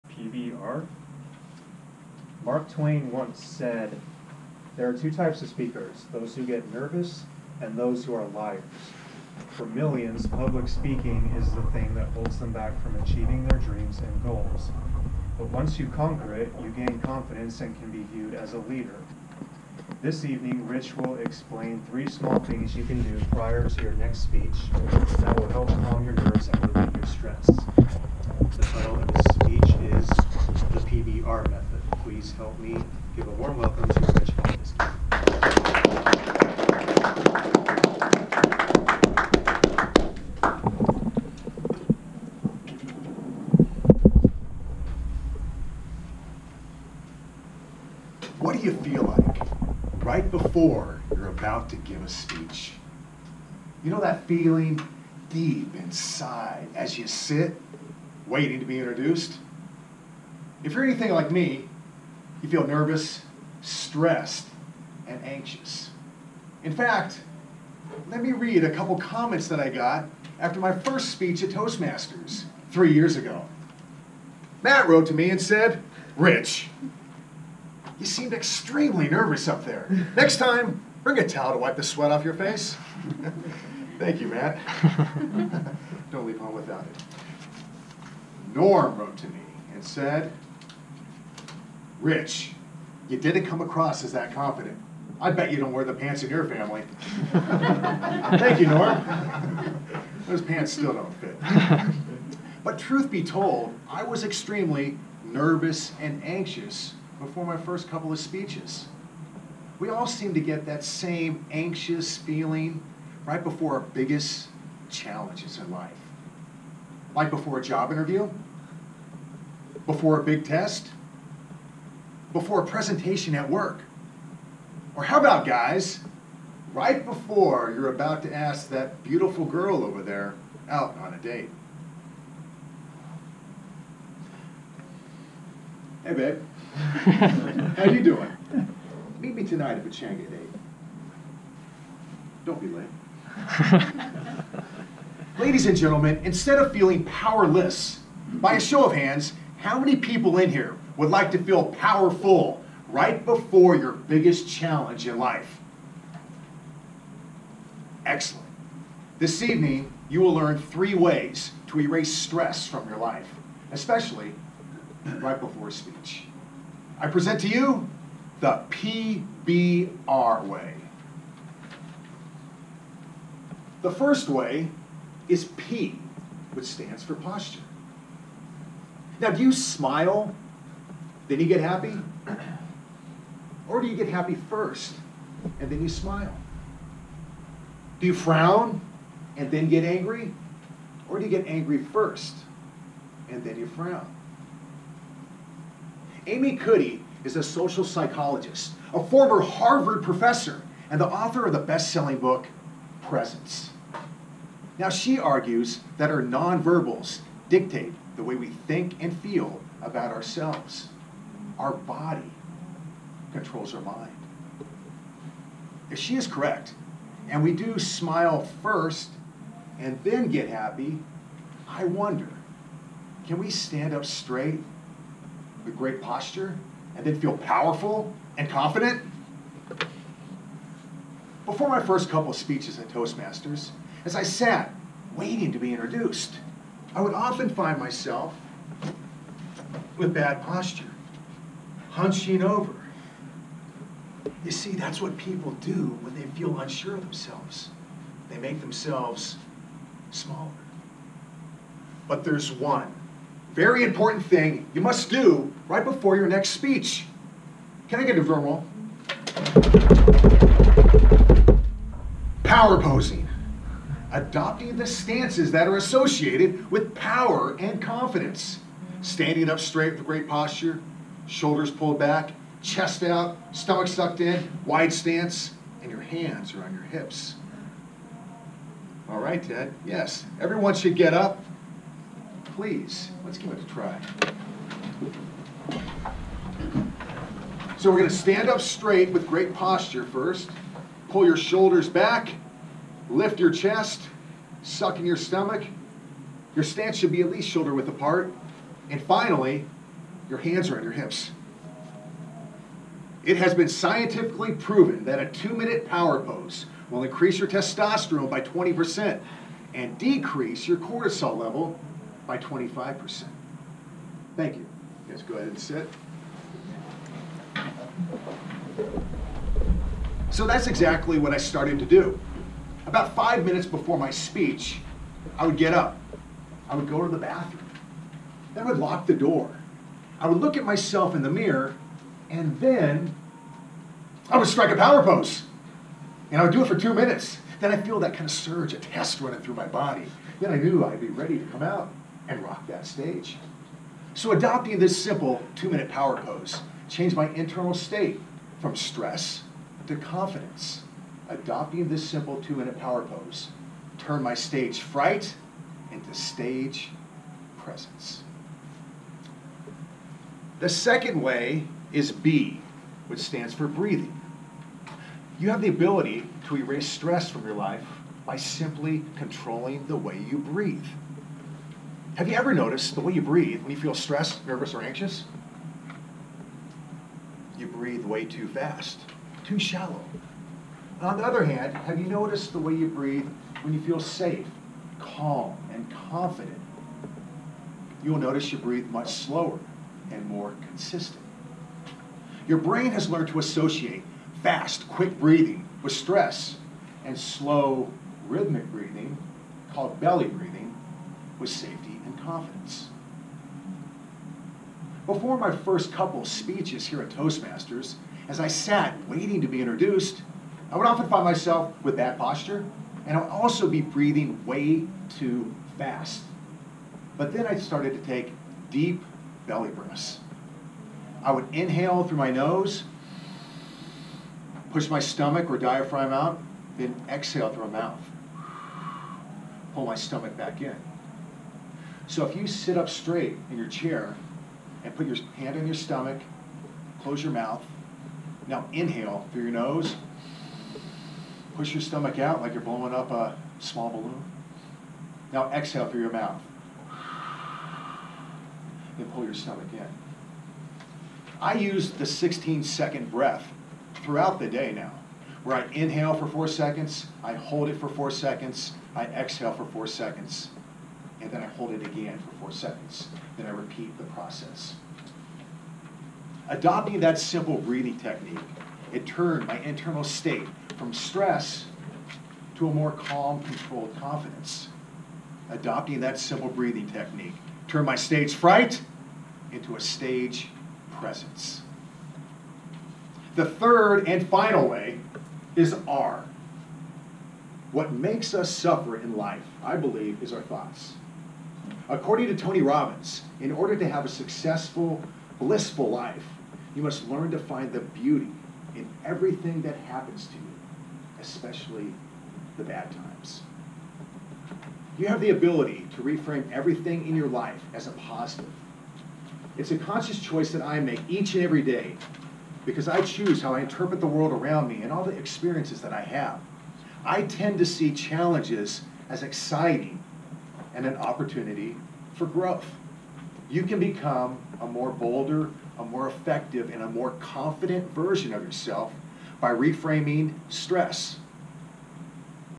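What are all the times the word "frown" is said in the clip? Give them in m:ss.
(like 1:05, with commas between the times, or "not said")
3:08, 3:13.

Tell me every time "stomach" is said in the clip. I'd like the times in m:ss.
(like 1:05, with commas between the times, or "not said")
4:33, 4:55, 7:04, 7:09, 7:15, 7:21, 7:29.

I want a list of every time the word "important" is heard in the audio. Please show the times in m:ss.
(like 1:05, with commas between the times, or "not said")
4:13.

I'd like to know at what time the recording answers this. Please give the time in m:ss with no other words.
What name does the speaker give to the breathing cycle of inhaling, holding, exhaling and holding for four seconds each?
7:32.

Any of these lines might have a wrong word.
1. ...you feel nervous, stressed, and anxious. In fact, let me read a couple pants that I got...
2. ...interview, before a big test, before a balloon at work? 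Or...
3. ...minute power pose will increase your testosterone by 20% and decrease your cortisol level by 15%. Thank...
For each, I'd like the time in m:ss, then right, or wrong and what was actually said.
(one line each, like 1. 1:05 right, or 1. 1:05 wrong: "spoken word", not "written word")
1. 1:02 wrong: "comments", not "pants"
2. 1:57 wrong: "presentation", not "balloon"
3. 5:05 wrong: "25", not "15".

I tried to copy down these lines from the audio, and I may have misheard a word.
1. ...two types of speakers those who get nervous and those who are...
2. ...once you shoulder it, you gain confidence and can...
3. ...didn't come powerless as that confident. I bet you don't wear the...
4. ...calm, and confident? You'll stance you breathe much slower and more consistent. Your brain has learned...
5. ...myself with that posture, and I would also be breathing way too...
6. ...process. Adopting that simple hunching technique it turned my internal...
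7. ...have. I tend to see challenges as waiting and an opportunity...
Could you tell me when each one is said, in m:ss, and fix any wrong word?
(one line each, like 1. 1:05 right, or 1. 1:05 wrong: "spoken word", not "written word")
1. 0:04 right
2. 0:15 wrong: "conquer", not "shoulder"
3. 1:33 wrong: "across", not "powerless"
4. 6:24 wrong: "notice", not "stance"
5. 6:51 right
6. 7:44 wrong: "breathing", not "hunching"
7. 8:36 wrong: "exciting", not "waiting".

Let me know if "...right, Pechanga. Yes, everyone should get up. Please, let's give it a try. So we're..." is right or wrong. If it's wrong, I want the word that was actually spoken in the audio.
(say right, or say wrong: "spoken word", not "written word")
wrong: "Ted", not "Pechanga".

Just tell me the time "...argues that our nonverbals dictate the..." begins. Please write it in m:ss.
3:25.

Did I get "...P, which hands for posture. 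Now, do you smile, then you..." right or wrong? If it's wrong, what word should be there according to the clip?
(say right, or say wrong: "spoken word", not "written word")
wrong: "stands", not "hands".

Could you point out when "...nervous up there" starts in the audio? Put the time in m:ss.
1:19.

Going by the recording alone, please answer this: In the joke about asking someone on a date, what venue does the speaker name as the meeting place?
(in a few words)
Pechanga.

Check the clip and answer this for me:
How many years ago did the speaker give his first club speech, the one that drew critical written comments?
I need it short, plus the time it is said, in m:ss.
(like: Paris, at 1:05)
3, at 1:12.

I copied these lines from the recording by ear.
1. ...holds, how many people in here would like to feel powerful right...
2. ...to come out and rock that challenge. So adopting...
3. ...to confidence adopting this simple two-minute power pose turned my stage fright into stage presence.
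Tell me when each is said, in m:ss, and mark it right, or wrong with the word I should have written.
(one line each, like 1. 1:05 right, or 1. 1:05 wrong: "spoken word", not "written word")
1. 2:28 wrong: "hands", not "holds"
2. 5:41 wrong: "stage", not "challenge"
3. 5:49 right.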